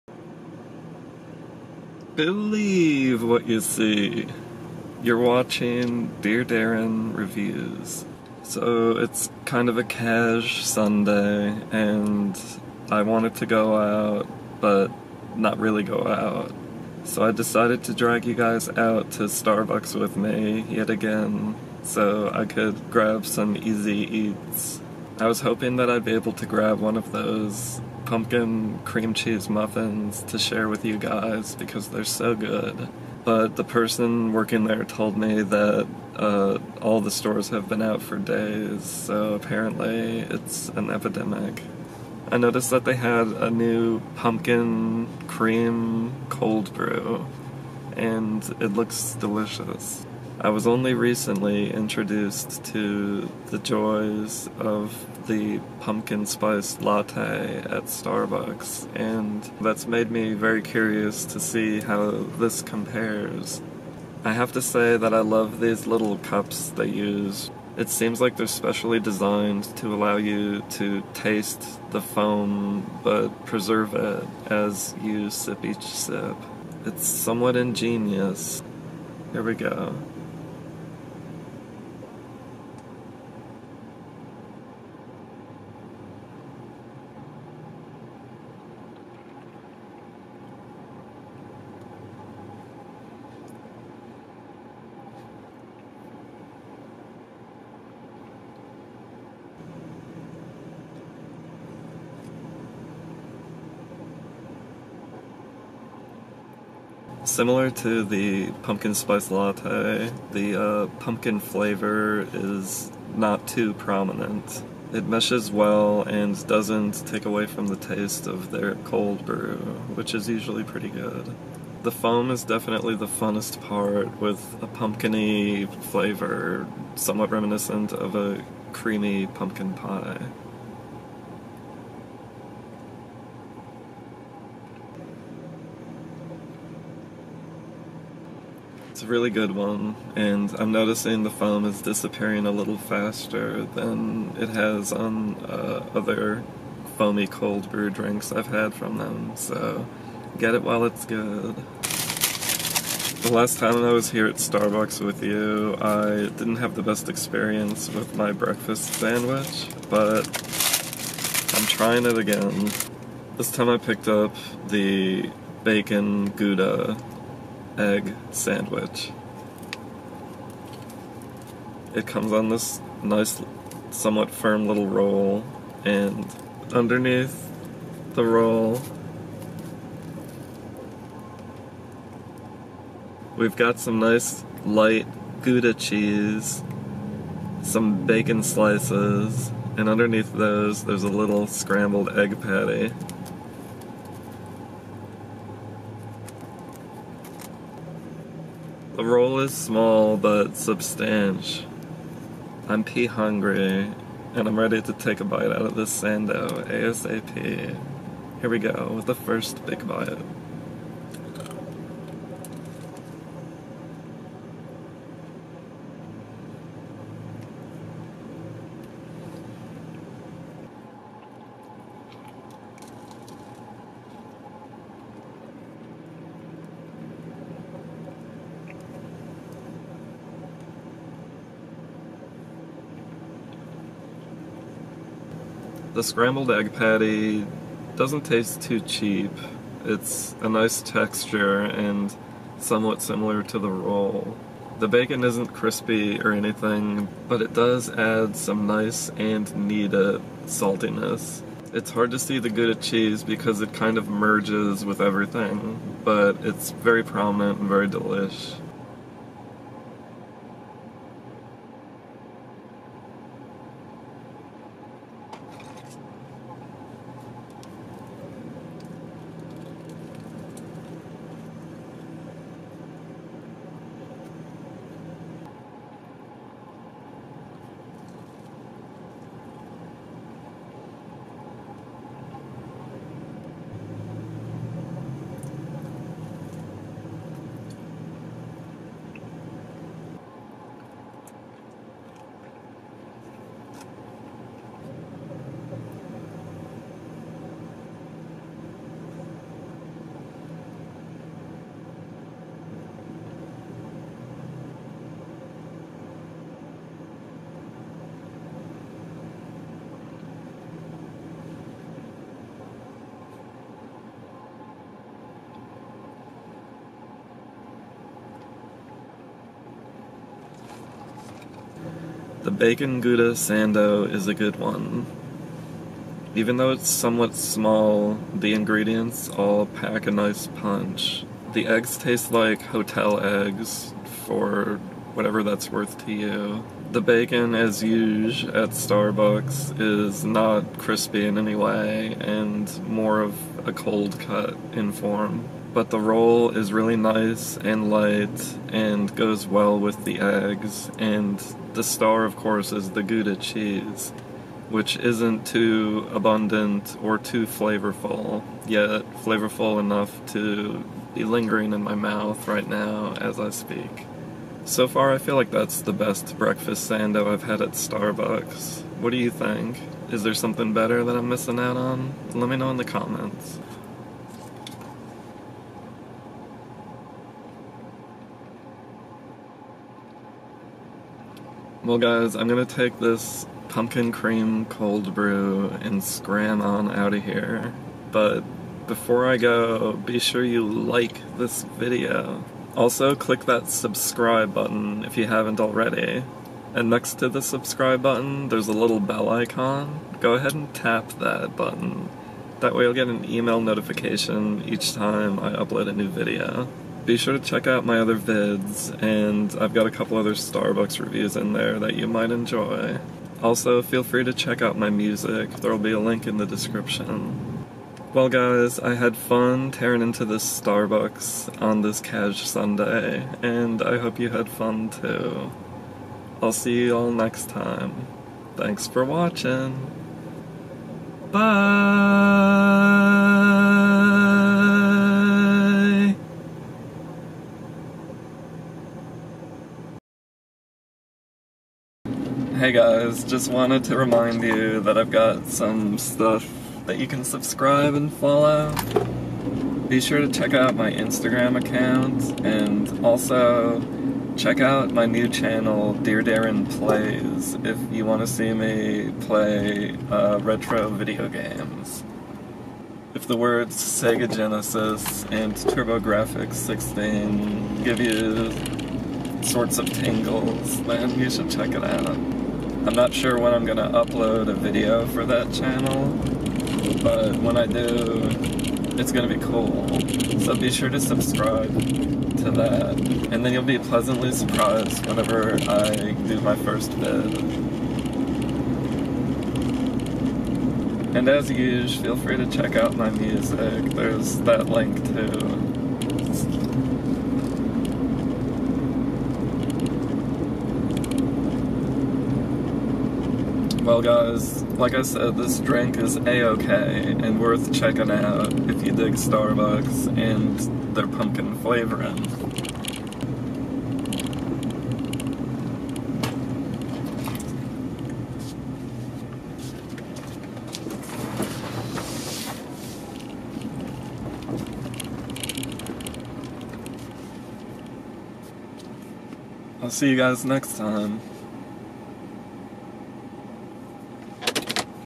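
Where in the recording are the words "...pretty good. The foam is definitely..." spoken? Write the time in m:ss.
2:00.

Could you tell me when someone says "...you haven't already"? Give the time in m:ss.
6:35.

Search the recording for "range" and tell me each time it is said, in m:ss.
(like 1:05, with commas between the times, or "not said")
not said.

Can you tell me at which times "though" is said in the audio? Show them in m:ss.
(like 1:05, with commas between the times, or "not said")
5:26.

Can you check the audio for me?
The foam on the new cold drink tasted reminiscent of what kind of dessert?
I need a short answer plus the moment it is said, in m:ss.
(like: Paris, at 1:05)
creamy pumpkin pie, at 2:08.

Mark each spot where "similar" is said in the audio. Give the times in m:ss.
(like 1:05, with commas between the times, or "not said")
1:47, 4:03.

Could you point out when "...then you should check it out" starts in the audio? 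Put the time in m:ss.
7:50.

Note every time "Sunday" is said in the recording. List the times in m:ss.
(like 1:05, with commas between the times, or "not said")
0:10, 7:02.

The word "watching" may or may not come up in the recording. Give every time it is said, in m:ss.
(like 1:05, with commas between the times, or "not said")
0:05, 7:09.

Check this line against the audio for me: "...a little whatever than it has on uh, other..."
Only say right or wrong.
wrong.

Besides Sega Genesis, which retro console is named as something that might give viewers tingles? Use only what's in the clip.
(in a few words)
TurboGrafx 16.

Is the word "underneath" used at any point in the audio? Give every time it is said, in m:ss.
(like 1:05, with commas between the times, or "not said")
2:56, 3:09.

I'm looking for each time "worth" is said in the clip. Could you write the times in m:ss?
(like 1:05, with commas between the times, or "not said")
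5:35, 8:27.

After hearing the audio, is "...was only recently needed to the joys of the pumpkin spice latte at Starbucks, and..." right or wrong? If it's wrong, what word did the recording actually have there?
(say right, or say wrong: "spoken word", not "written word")
wrong: "introduced", not "needed".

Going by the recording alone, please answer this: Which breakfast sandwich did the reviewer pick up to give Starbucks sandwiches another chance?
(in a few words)
bacon gouda egg sandwich.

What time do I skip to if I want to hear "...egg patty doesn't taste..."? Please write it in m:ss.
3:56.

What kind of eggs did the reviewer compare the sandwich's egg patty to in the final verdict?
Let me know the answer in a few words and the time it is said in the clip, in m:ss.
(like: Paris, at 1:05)
hotel eggs, at 5:32.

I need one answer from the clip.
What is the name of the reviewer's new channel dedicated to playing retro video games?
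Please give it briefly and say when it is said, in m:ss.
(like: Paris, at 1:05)
Dear Darren Plays, at 7:35.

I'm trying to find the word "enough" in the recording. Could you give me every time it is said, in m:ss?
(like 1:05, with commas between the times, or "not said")
5:59.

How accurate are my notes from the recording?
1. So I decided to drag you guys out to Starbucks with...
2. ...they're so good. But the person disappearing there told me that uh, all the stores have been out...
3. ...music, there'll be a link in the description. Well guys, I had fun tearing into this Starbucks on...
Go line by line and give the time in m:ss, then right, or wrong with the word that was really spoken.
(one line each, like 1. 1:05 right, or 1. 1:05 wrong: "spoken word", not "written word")
1. 0:17 right
2. 0:31 wrong: "working", not "disappearing"
3. 6:54 right.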